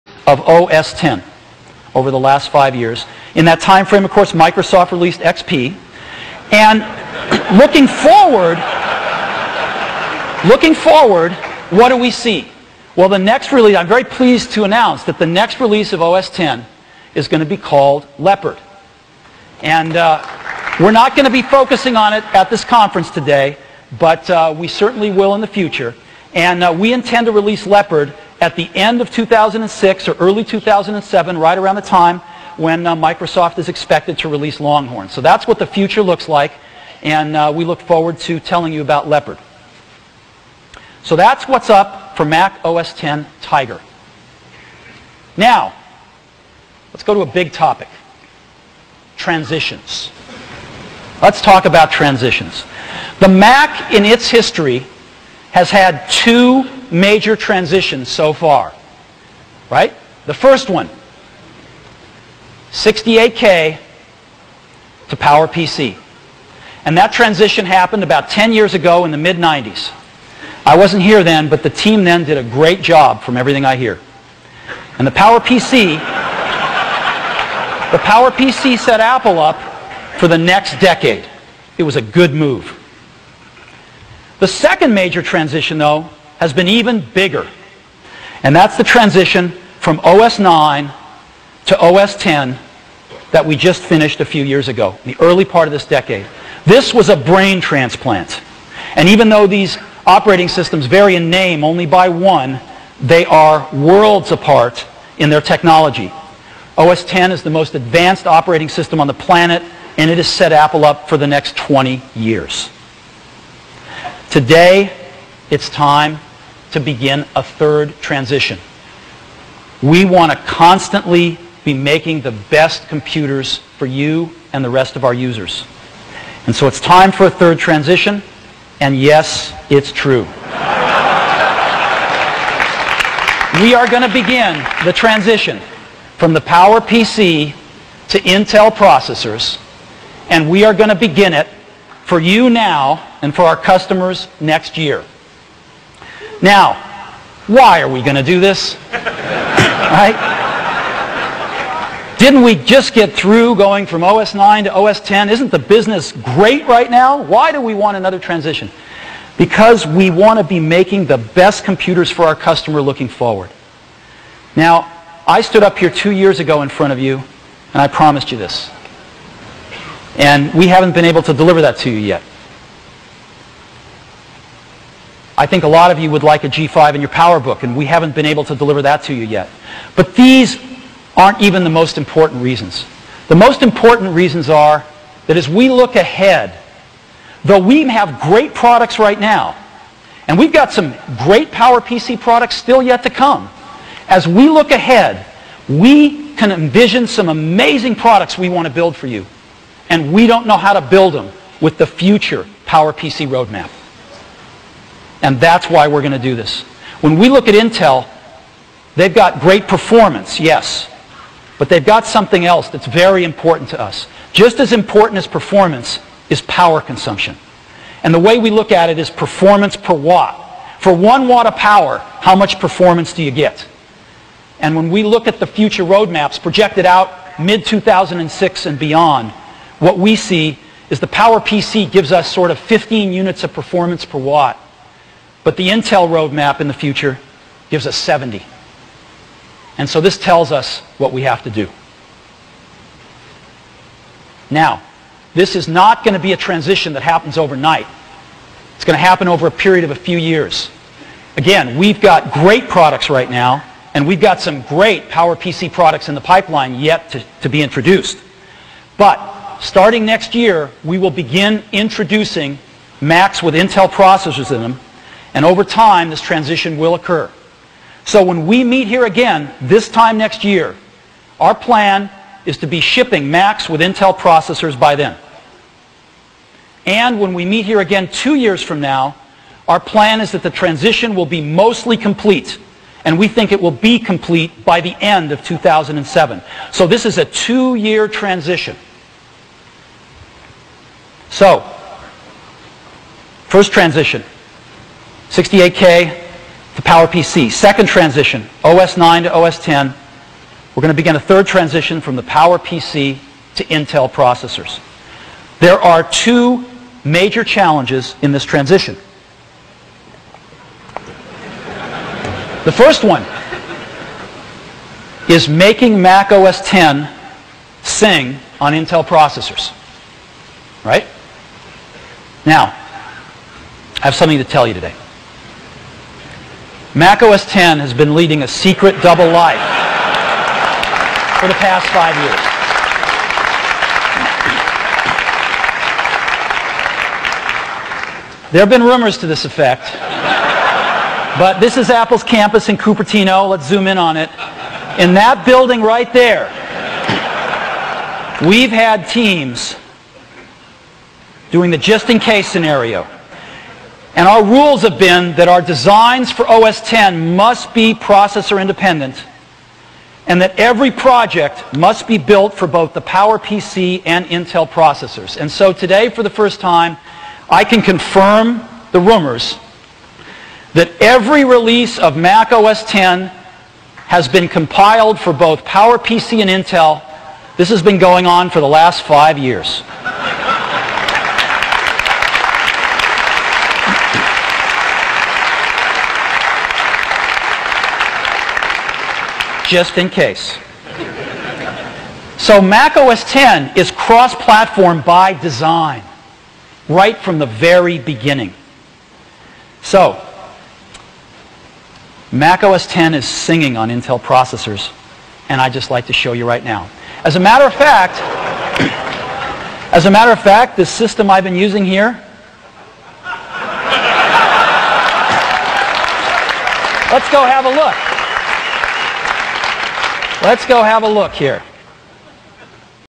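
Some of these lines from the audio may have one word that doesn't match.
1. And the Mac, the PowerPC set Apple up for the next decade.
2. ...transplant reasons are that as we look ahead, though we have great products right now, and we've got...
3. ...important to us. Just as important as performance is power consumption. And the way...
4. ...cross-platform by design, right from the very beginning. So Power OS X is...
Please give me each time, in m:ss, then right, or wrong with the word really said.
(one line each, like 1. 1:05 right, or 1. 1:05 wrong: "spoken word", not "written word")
1. 1:14 wrong: "PowerPC", not "Mac"
2. 3:03 wrong: "important", not "transplant"
3. 3:33 right
4. 6:33 wrong: "Mac", not "Power".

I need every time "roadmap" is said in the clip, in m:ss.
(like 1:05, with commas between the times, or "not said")
3:23, 3:45, 3:56.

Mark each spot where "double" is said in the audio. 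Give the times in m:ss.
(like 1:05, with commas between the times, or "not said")
5:29.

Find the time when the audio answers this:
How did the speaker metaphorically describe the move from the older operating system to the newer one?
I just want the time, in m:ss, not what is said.
1:37.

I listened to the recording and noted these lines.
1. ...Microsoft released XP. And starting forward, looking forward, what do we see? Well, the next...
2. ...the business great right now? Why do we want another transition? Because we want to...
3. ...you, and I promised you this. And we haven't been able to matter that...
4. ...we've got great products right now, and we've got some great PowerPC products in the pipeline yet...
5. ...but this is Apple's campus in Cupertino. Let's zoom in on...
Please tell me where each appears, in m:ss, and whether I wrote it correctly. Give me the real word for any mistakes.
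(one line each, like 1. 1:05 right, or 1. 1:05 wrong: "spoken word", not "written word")
1. 0:04 wrong: "looking", not "starting"
2. 2:35 right
3. 2:46 wrong: "deliver", not "matter"
4. 4:11 right
5. 5:41 right.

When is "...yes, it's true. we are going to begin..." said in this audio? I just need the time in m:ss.
2:08.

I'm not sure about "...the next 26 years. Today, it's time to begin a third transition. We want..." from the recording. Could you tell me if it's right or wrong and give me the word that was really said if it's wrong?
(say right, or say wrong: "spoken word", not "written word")
wrong: "20", not "26".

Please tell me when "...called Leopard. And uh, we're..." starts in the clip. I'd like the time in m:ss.
0:17.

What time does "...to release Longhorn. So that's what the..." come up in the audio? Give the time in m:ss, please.
0:34.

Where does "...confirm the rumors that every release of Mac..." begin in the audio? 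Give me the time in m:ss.
6:07.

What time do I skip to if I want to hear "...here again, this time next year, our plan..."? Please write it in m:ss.
4:28.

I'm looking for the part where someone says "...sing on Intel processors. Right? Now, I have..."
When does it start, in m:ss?
5:17.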